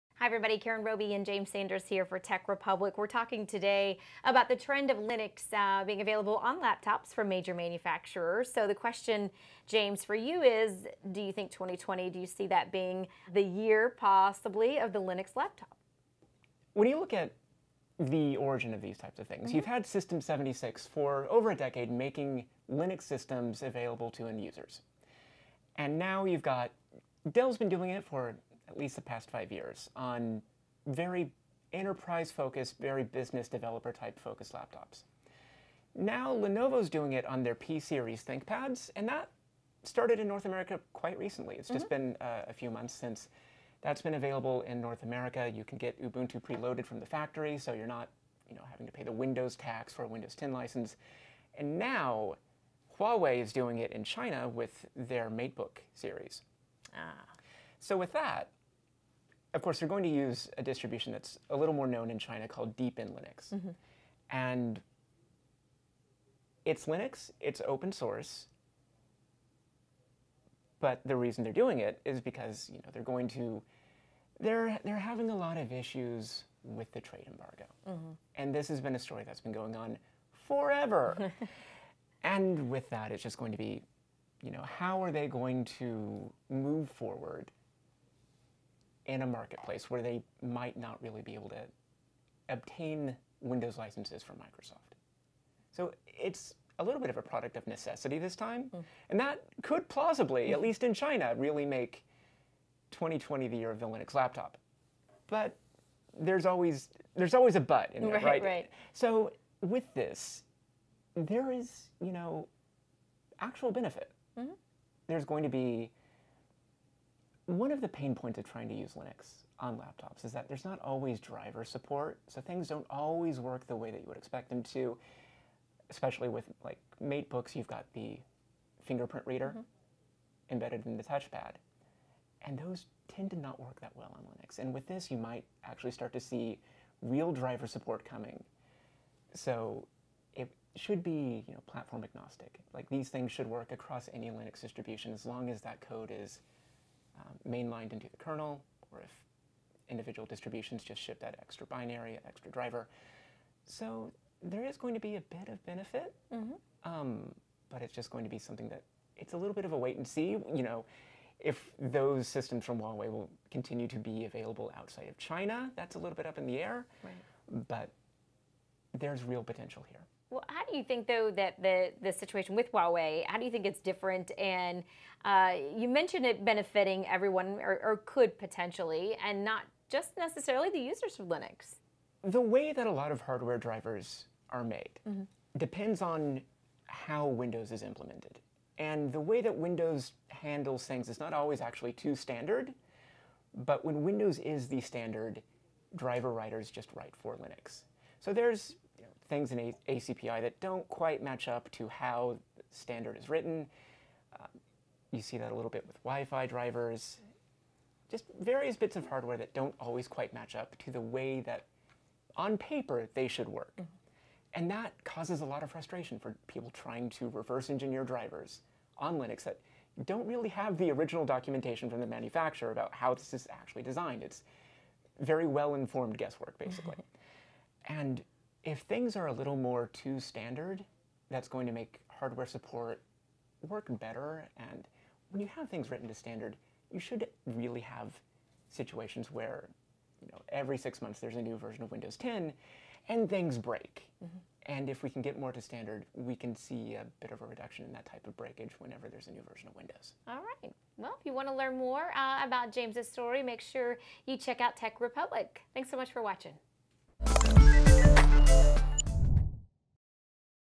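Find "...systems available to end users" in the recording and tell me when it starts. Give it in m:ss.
0:23.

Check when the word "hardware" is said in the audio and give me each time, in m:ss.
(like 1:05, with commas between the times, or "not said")
3:03, 3:29, 3:52.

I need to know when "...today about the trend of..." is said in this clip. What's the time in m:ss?
0:03.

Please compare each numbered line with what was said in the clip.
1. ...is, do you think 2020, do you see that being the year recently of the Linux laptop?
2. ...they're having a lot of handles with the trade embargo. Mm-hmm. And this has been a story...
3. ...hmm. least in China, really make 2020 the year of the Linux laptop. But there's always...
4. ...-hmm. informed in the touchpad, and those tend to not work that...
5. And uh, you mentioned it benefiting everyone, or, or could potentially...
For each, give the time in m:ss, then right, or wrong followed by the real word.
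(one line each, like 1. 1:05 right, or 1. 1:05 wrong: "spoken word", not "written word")
1. 0:10 wrong: "possibly", not "recently"
2. 1:14 wrong: "issues", not "handles"
3. 1:40 right
4. 2:09 wrong: "embedded", not "informed"
5. 2:54 right.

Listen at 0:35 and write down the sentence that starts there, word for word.
Now Lenovo's doing it on their P series ThinkPads, and that started in North America quite recently.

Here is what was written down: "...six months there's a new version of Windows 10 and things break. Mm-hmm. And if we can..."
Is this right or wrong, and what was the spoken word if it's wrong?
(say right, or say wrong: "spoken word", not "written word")
right.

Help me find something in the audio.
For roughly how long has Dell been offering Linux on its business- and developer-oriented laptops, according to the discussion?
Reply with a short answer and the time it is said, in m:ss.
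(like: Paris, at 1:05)
5 years, at 0:29.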